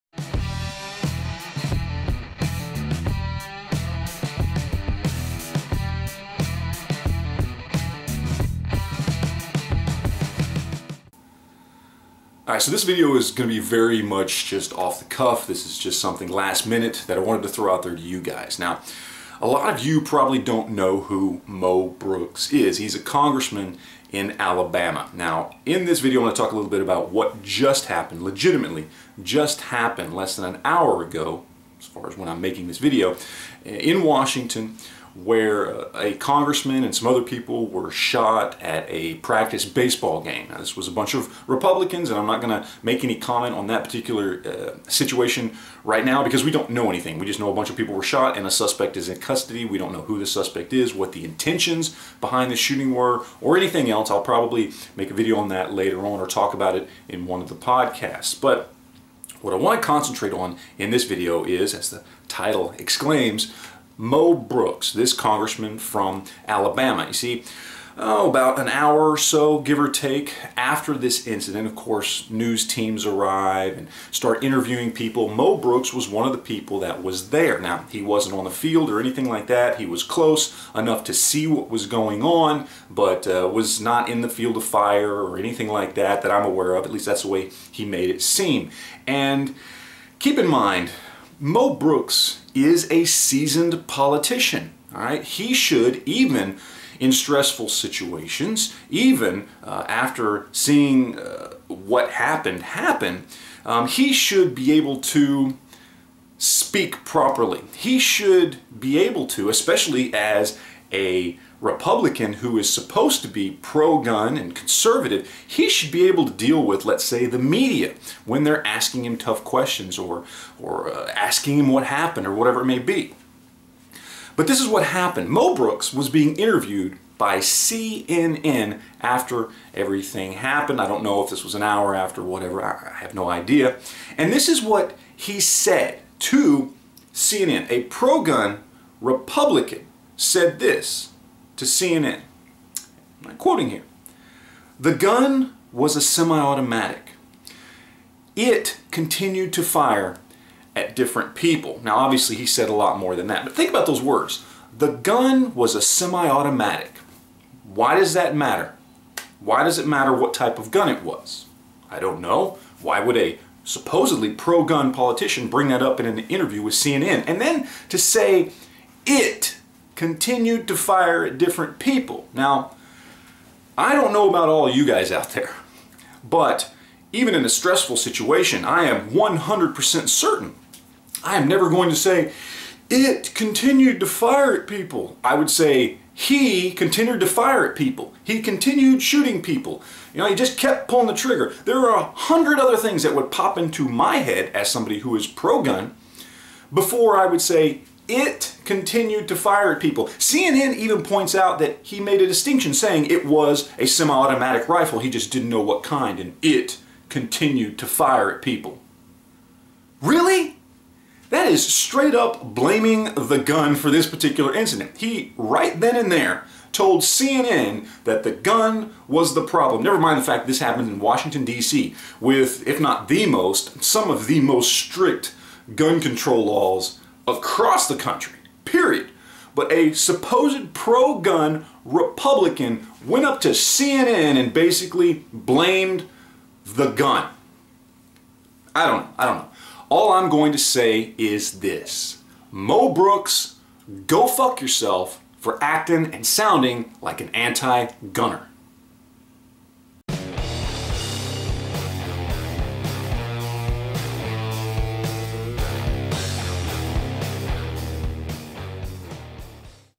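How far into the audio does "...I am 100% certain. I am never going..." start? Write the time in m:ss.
2:58.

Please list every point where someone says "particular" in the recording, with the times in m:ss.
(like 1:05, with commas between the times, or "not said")
0:43, 3:34.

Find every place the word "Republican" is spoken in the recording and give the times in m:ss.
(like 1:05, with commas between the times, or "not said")
0:41, 1:51, 2:18, 3:51.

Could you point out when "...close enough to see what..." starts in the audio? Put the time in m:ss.
1:20.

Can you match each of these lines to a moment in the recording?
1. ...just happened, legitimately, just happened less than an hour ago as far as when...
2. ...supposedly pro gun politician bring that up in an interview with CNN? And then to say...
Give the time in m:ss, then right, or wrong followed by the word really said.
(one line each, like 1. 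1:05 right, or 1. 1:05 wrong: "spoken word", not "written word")
1. 0:27 right
2. 2:43 right.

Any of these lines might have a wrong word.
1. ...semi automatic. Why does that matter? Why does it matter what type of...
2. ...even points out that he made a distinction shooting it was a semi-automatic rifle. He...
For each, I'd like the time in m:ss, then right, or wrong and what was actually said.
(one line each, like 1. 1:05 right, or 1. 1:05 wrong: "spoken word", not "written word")
1. 2:35 right
2. 3:20 wrong: "saying", not "shooting".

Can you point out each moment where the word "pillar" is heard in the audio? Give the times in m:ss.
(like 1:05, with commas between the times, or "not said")
not said.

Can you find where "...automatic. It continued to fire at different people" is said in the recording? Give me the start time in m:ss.
2:26.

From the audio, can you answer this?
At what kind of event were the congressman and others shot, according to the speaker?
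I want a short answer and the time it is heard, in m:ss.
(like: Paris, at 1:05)
practice baseball game, at 0:39.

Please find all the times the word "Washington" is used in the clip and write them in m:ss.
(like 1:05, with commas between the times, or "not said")
0:34, 3:40.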